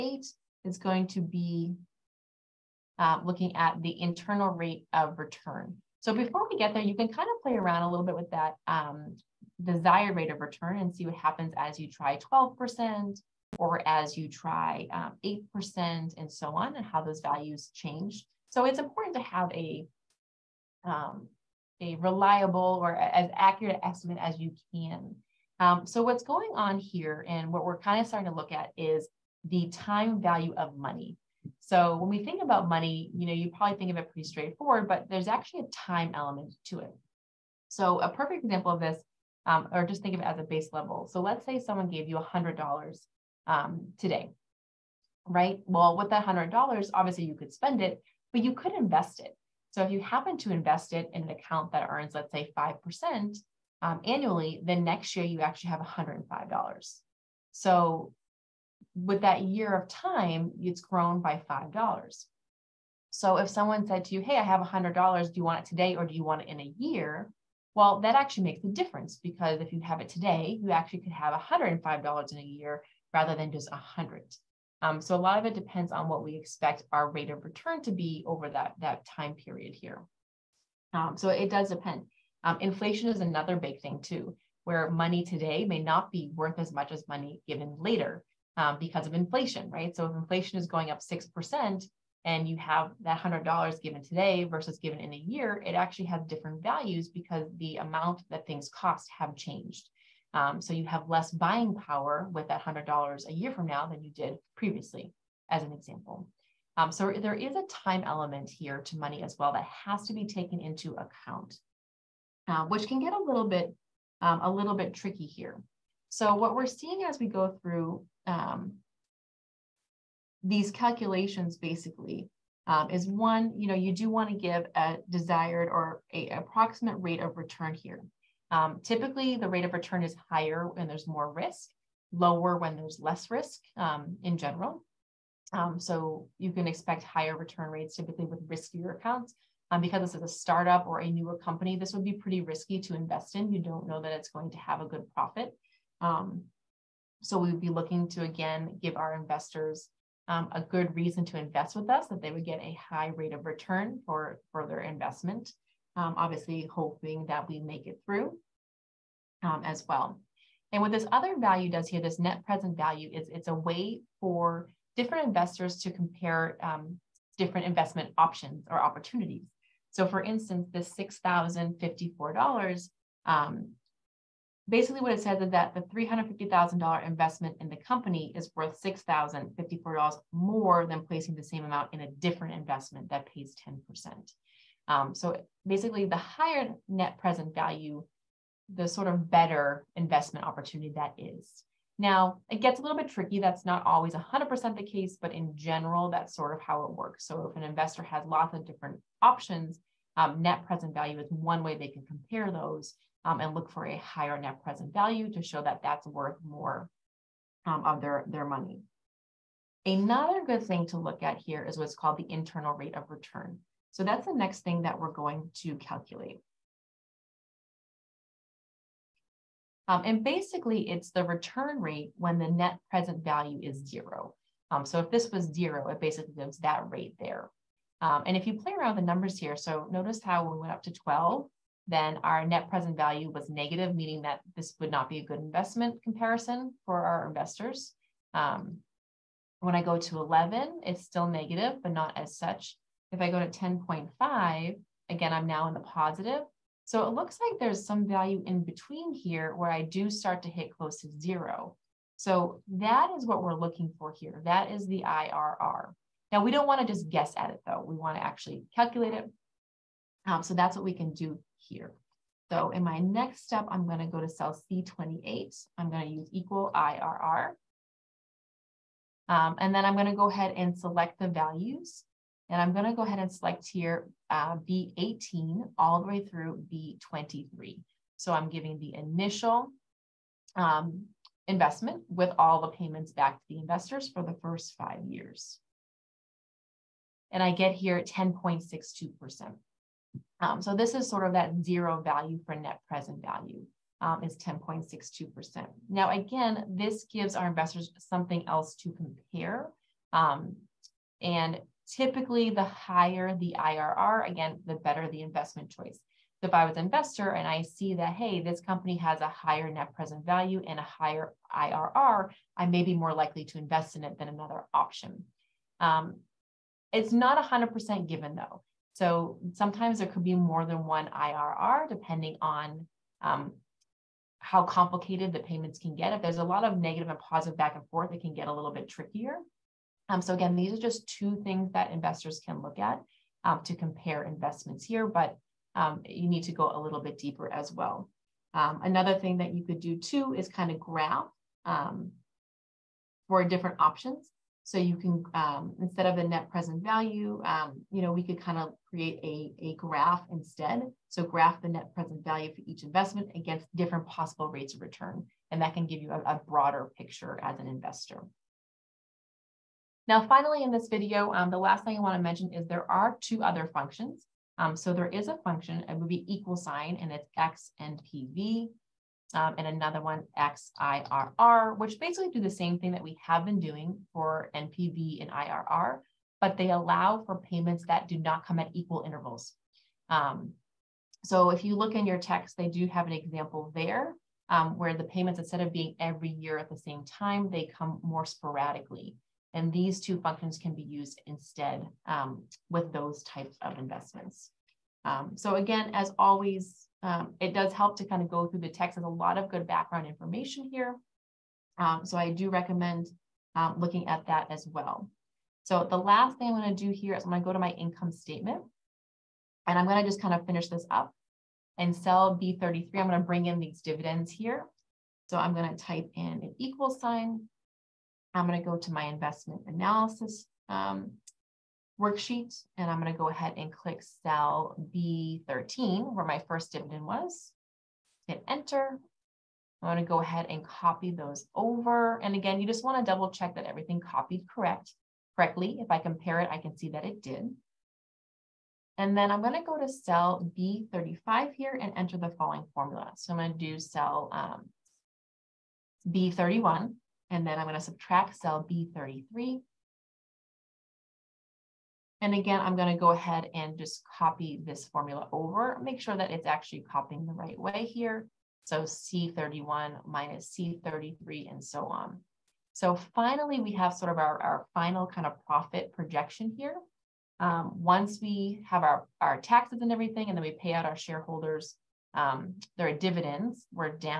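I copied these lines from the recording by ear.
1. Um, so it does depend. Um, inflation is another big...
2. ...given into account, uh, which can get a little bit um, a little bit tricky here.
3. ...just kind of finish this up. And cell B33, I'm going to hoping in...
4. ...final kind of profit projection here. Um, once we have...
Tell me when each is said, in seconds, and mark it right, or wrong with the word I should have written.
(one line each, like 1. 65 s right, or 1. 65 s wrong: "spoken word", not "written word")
1. 80 s right
2. 110 s wrong: "taken", not "given"
3. 410 s wrong: "bring", not "hoping"
4. 464 s right.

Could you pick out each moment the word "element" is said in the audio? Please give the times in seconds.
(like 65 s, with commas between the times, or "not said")
36 s, 108 s.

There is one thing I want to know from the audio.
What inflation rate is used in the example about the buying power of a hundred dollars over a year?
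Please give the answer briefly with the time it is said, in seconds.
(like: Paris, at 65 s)
6%, at 91 s.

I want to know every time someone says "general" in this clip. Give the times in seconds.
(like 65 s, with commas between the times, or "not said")
134 s, 195 s.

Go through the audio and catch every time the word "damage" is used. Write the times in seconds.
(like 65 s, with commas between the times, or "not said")
not said.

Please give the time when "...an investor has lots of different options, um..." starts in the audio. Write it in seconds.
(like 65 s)
197 s.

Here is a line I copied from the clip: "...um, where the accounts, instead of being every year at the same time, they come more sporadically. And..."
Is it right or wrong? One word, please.
wrong.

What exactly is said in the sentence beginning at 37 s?
So a perfect example of this, um, or just think of it as a base level.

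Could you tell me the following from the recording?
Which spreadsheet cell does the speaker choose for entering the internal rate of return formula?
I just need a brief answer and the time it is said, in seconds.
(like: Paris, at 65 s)
C28, at 264 s.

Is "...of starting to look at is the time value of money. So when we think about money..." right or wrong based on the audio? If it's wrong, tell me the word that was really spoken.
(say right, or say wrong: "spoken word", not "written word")
right.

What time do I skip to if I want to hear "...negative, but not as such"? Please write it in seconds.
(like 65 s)
241 s.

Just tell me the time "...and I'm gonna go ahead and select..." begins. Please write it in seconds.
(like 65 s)
272 s.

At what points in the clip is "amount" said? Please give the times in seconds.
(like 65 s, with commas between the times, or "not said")
97 s, 181 s.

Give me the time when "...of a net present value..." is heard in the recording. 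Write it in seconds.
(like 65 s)
346 s.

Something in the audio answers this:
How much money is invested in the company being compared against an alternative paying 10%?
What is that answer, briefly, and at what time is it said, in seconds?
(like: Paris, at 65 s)
$350,000, at 175 s.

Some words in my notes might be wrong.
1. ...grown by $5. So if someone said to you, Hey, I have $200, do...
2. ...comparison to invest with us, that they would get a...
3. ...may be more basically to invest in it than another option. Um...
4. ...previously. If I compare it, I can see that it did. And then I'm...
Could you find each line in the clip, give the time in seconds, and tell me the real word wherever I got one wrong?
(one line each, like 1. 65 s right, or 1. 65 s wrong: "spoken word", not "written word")
1. 60 s wrong: "100", not "200"
2. 150 s wrong: "reason", not "comparison"
3. 312 s wrong: "likely", not "basically"
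4. 435 s wrong: "correctly", not "previously".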